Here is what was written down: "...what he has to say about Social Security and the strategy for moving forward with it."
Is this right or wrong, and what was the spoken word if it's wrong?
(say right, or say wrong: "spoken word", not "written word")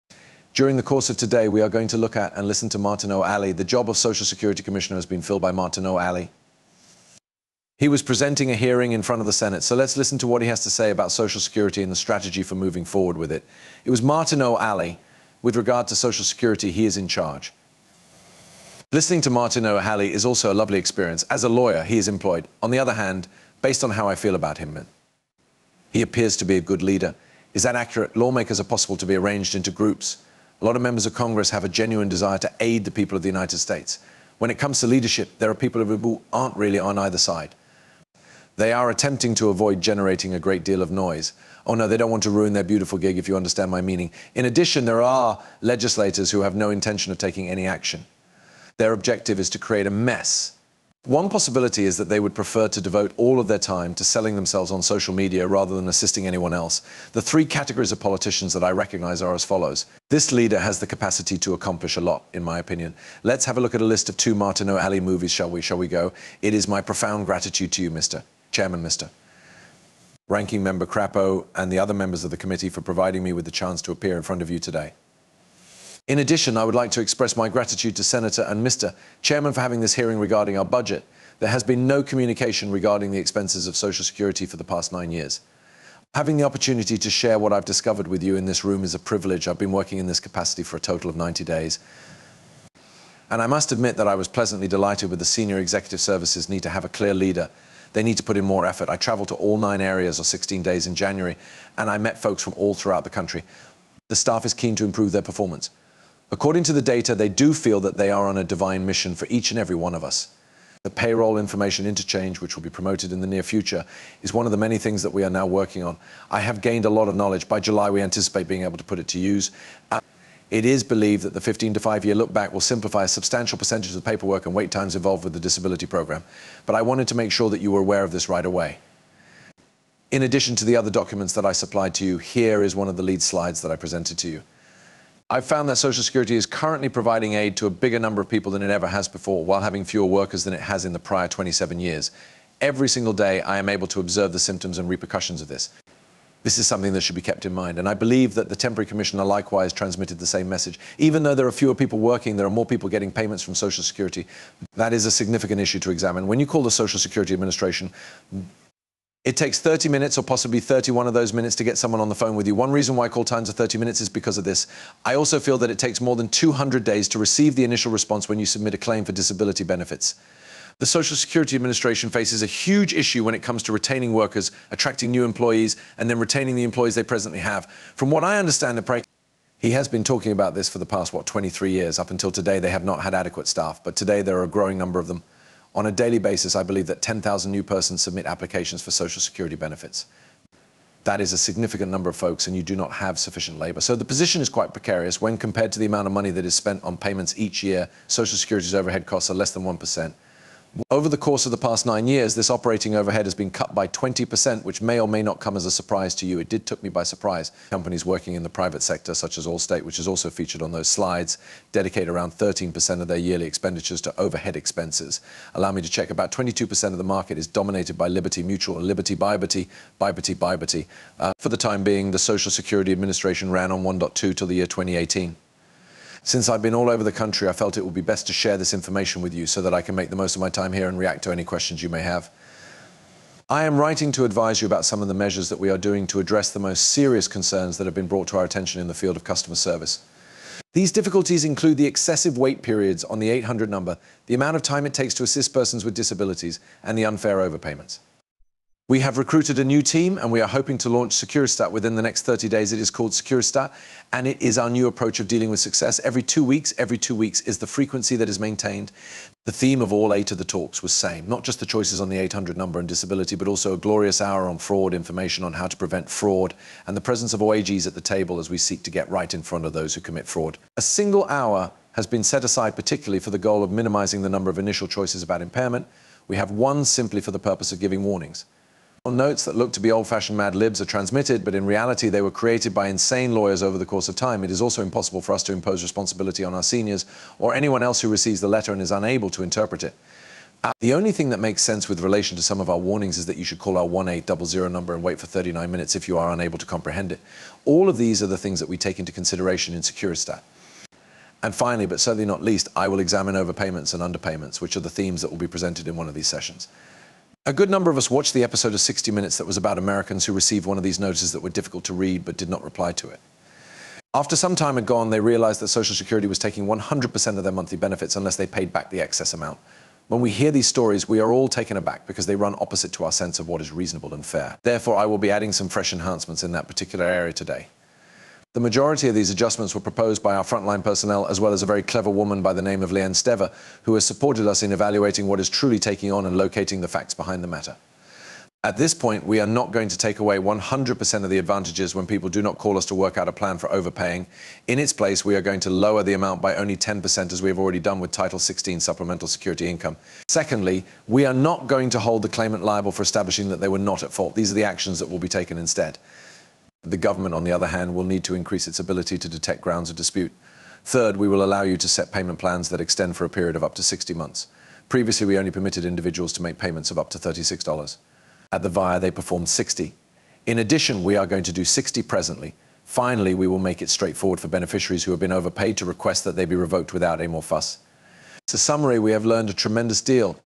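right.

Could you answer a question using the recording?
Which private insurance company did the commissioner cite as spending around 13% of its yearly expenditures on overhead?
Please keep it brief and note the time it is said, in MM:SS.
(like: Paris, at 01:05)
Allstate, at 03:29.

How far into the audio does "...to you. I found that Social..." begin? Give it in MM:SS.
02:14.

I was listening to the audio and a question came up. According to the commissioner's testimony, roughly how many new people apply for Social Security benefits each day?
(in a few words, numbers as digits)
10,000.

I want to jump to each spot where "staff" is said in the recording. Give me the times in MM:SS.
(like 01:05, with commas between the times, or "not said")
01:44, 03:03.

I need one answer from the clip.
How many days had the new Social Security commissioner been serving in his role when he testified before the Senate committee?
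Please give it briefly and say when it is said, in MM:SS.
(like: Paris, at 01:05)
90, at 01:31.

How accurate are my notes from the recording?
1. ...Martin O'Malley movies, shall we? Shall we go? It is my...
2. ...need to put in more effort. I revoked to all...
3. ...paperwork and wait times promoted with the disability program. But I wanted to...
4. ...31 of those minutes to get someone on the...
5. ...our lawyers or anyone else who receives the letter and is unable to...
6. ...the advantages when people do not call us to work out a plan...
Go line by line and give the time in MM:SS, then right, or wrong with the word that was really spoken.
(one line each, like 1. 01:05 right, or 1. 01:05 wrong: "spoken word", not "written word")
1. 01:04 right
2. 01:38 wrong: "traveled", not "revoked"
3. 02:04 wrong: "involved", not "promoted"
4. 02:40 right
5. 04:46 wrong: "seniors", not "lawyers"
6. 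05:41 right.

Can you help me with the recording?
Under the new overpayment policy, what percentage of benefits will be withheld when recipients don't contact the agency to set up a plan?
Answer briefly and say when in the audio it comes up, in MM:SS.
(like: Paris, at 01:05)
10%, at 05:46.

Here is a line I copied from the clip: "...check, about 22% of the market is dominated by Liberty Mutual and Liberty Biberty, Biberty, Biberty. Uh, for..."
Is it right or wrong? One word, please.
right.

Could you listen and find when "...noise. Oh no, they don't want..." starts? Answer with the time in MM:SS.
00:40.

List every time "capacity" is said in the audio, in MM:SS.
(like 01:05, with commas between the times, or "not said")
01:00, 01:30.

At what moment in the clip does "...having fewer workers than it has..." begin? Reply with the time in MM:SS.
02:19.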